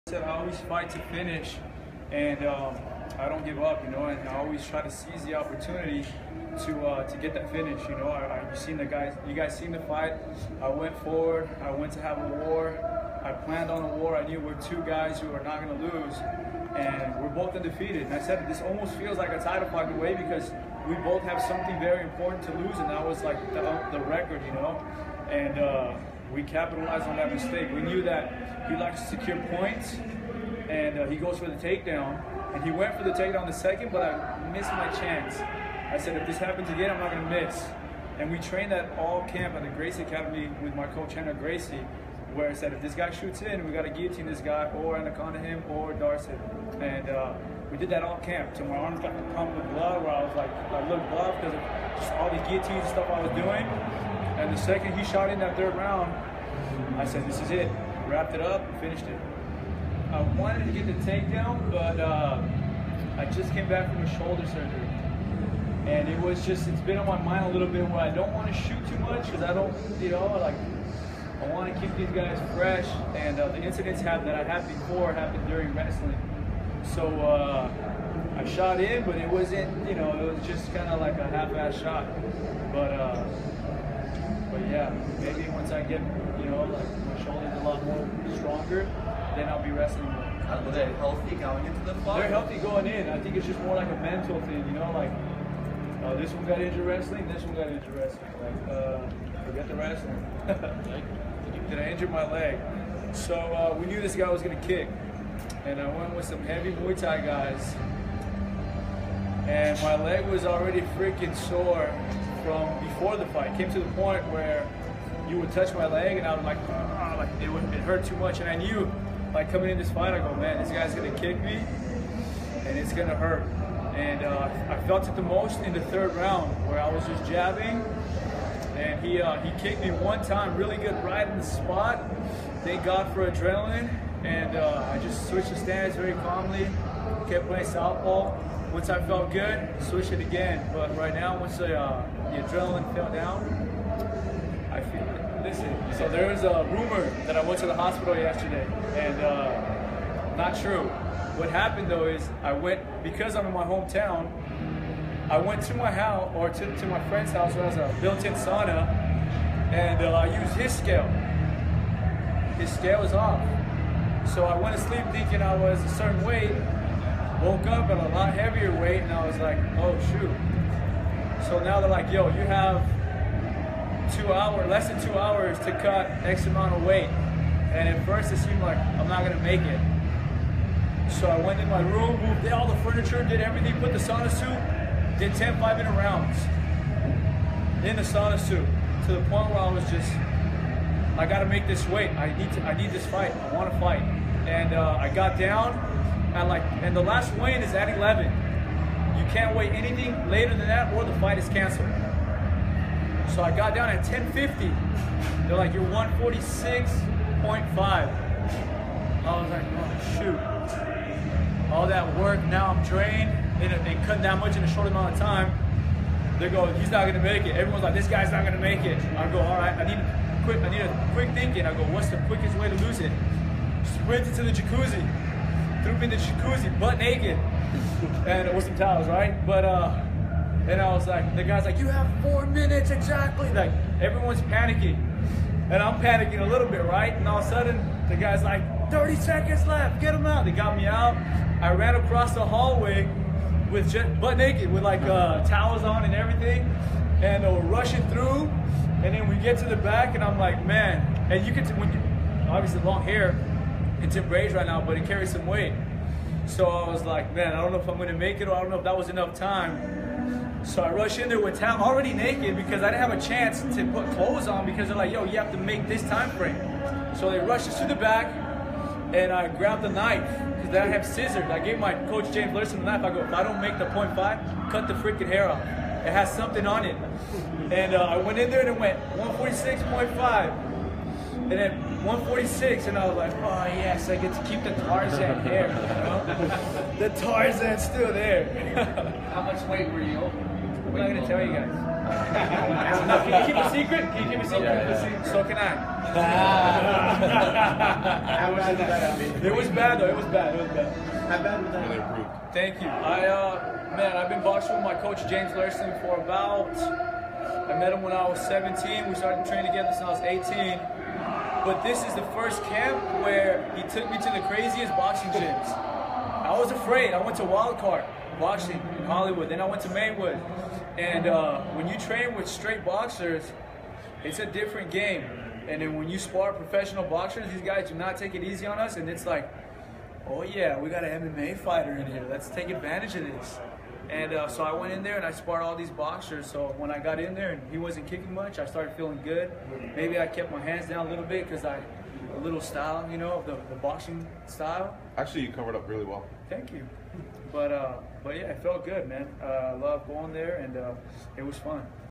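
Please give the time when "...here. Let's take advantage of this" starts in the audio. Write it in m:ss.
5:32.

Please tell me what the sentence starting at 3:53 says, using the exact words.
Like everyone's panicking, and I'm panicking a little bit, right?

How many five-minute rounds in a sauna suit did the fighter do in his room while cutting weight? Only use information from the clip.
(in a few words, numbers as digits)
10.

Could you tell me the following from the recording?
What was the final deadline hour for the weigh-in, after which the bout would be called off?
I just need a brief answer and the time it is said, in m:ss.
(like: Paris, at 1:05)
11, at 3:17.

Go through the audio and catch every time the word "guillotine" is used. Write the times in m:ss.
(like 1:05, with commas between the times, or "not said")
0:43, 0:52.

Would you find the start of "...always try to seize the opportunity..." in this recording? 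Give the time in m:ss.
0:04.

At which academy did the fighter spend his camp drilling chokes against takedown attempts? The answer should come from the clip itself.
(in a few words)
Gracie Academy.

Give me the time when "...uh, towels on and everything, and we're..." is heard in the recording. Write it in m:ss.
4:05.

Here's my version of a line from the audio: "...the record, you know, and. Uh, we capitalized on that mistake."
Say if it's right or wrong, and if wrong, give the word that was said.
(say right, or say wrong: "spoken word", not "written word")
right.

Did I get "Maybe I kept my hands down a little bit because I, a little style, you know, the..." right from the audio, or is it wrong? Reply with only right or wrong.
right.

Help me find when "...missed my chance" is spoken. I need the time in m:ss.
0:34.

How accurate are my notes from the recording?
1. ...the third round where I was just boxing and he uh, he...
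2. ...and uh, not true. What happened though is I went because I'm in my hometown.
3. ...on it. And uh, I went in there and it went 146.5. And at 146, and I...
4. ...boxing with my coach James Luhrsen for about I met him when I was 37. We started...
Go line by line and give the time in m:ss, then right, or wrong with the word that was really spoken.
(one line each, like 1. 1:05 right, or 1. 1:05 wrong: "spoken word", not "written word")
1. 2:05 wrong: "jabbing", not "boxing"
2. 2:28 right
3. 4:36 right
4. 5:04 wrong: "17", not "37".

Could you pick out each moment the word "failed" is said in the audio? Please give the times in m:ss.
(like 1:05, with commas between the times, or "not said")
not said.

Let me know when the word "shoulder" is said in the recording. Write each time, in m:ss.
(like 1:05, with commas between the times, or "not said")
1:04, 1:27.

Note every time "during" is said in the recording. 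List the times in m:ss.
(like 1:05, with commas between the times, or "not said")
1:15.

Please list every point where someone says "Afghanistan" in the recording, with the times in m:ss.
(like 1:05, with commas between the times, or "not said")
not said.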